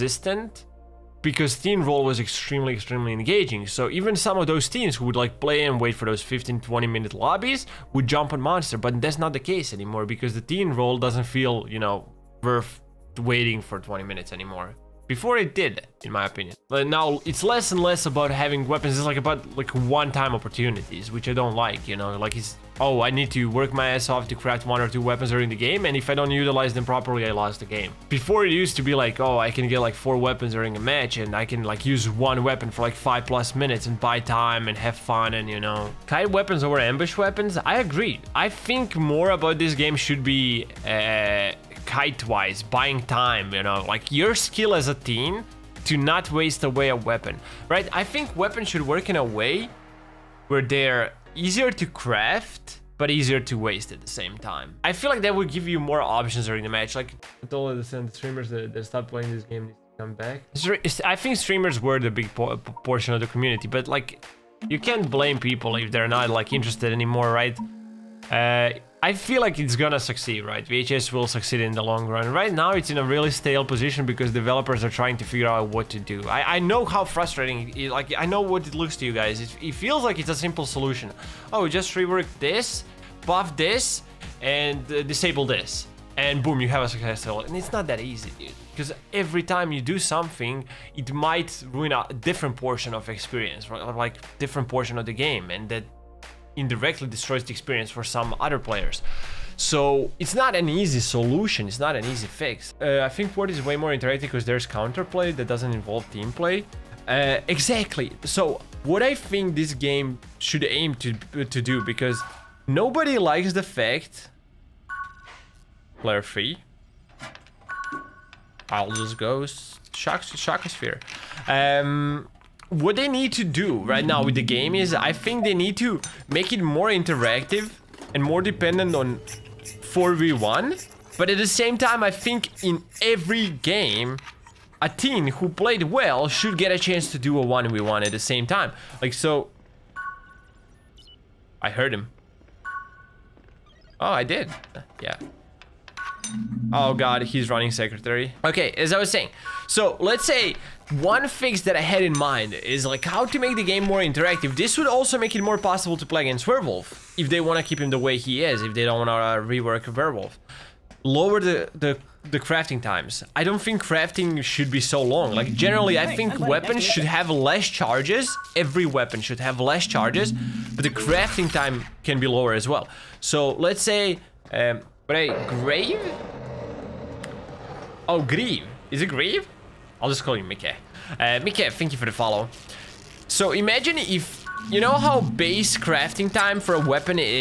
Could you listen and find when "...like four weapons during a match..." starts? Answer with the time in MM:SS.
00:29.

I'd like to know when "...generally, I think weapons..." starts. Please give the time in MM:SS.
02:45.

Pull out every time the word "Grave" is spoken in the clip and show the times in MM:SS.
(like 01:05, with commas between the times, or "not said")
02:55.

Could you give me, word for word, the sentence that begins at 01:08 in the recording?
Uh, I feel like it's gonna succeed, right?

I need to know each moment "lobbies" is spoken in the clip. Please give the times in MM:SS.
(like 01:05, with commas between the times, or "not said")
00:07.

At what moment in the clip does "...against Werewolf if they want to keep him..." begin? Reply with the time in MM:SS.
02:36.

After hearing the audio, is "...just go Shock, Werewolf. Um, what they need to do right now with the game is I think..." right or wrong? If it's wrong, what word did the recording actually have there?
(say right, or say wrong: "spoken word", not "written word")
wrong: "Shockosphere", not "Werewolf".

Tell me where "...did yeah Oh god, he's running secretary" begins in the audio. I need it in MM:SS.
02:24.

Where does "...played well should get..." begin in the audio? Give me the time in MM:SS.
02:15.